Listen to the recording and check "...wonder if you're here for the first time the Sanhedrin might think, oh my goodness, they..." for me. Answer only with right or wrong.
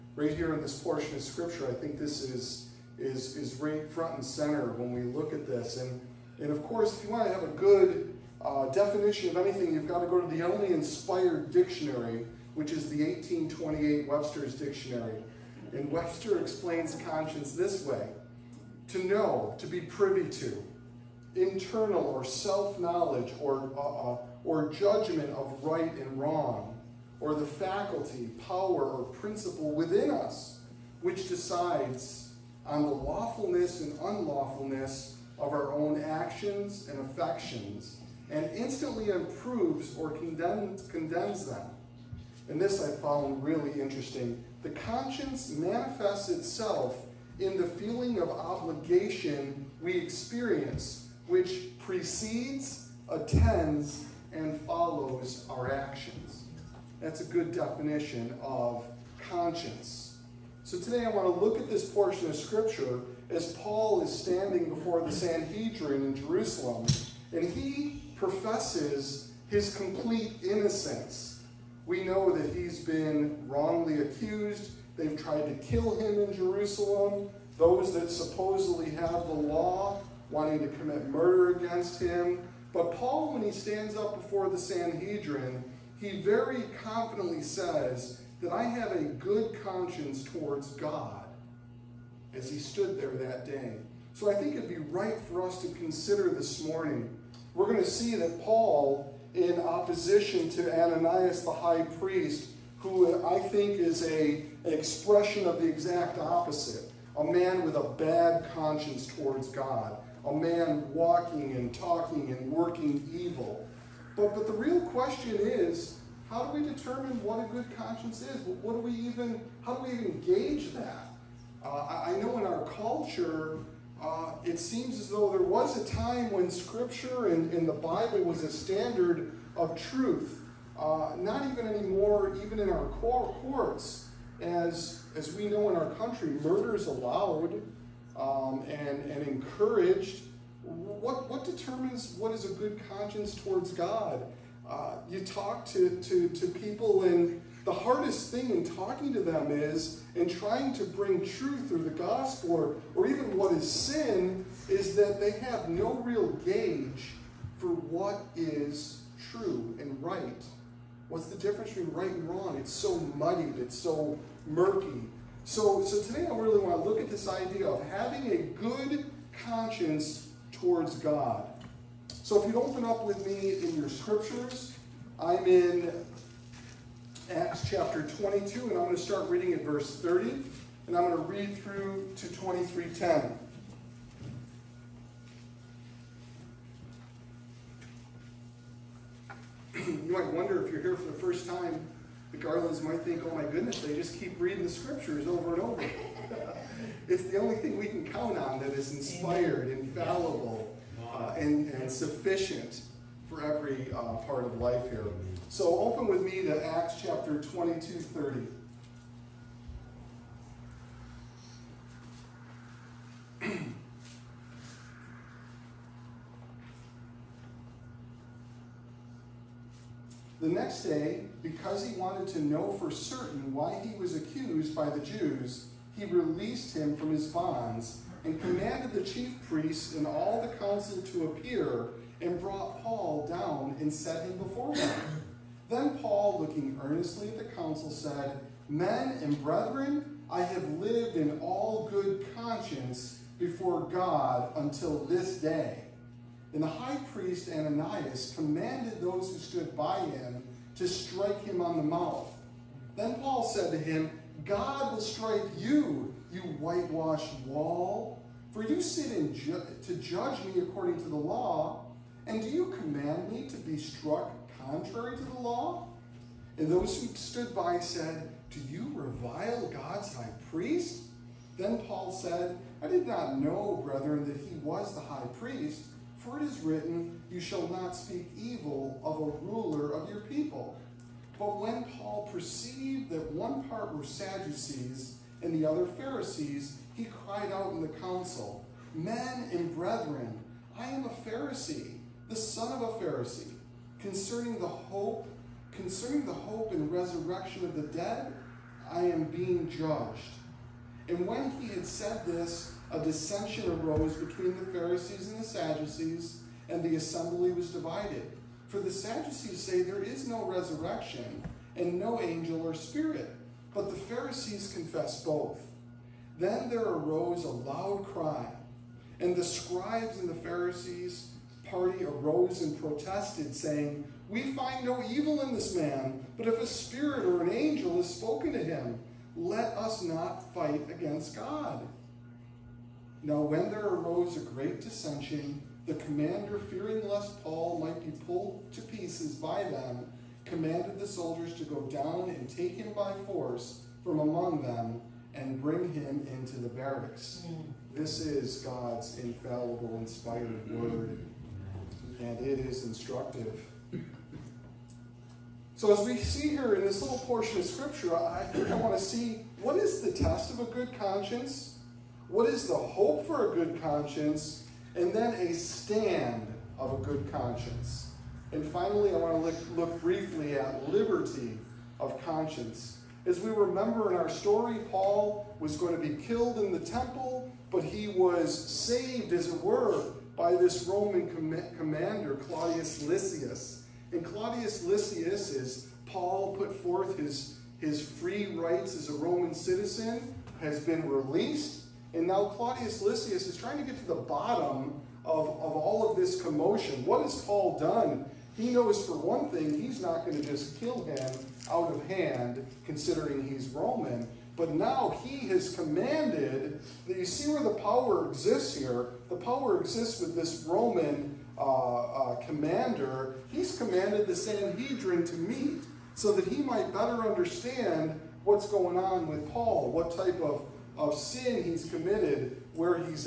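wrong.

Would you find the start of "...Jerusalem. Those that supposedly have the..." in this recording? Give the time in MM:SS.
01:16.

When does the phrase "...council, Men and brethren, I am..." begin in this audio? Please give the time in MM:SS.
04:47.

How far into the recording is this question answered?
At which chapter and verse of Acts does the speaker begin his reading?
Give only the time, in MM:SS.
02:57.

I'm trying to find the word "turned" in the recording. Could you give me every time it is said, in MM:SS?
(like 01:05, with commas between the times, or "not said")
not said.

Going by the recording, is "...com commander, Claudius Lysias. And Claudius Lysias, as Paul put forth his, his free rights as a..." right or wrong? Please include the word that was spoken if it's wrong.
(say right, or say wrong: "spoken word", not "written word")
right.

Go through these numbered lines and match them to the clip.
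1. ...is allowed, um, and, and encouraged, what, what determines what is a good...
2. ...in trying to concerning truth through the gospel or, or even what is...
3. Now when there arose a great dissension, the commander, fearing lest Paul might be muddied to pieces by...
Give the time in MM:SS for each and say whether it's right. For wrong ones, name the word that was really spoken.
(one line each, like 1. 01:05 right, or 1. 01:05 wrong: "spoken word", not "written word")
1. 02:16 right
2. 02:30 wrong: "bring", not "concerning"
3. 05:33 wrong: "pulled", not "muddied".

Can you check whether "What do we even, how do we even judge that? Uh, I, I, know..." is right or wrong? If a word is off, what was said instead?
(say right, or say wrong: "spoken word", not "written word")
wrong: "gauge", not "judge".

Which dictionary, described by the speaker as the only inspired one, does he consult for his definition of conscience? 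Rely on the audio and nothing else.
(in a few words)
1828 Webster's Dictionary.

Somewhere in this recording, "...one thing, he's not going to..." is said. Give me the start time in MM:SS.
06:39.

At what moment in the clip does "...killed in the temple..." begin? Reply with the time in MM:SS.
06:16.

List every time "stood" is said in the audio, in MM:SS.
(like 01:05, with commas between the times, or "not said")
01:32, 04:09, 04:27.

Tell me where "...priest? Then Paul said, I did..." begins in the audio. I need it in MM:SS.
04:30.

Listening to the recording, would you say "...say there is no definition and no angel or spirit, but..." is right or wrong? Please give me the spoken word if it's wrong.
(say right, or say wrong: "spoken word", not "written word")
wrong: "resurrection", not "definition".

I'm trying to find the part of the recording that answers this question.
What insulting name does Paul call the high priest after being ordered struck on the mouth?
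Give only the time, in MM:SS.
04:16.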